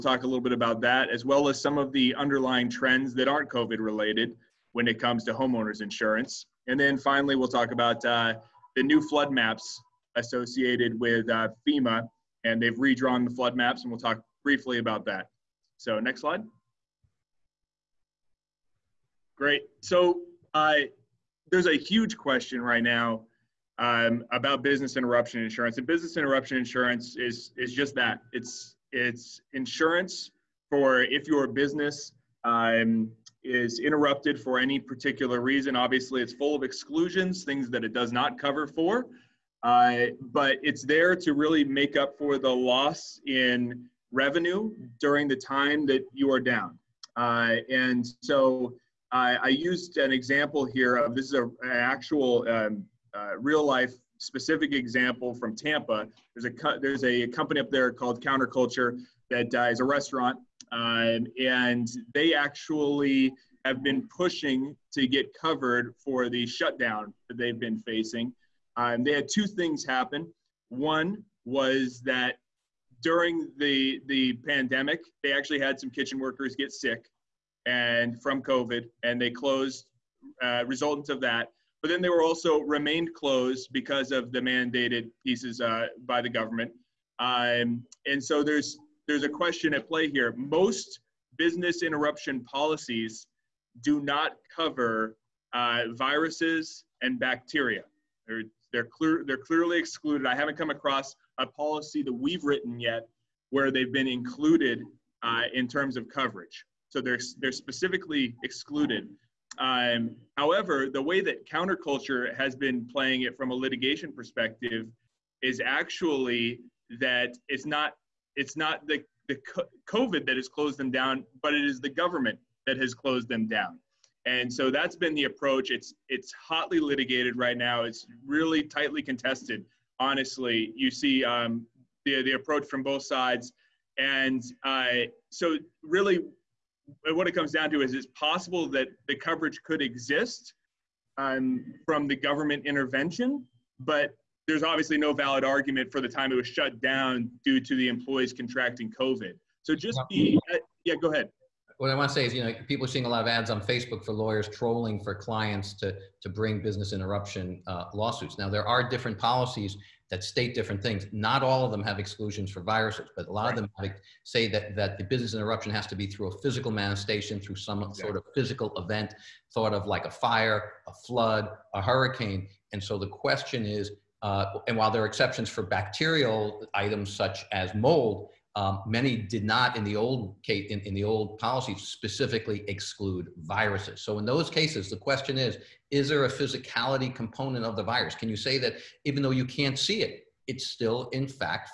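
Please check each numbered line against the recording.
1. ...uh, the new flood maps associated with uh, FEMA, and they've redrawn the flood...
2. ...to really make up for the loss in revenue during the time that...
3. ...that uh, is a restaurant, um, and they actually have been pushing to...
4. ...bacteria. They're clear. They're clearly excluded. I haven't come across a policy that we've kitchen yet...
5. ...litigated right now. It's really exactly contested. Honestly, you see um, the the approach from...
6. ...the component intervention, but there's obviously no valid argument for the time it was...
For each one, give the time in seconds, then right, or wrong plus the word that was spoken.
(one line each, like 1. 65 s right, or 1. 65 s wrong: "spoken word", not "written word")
1. 8 s right
2. 41 s right
3. 59 s right
4. 97 s wrong: "written", not "kitchen"
5. 126 s wrong: "tightly", not "exactly"
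6. 142 s wrong: "government", not "component".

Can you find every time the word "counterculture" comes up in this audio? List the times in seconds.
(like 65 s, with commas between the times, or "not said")
58 s, 111 s.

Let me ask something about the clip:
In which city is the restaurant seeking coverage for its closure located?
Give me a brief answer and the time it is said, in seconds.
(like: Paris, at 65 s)
Tampa, at 55 s.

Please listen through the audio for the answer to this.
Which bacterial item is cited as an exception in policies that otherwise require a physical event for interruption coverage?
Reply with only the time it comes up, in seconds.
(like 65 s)
177 s.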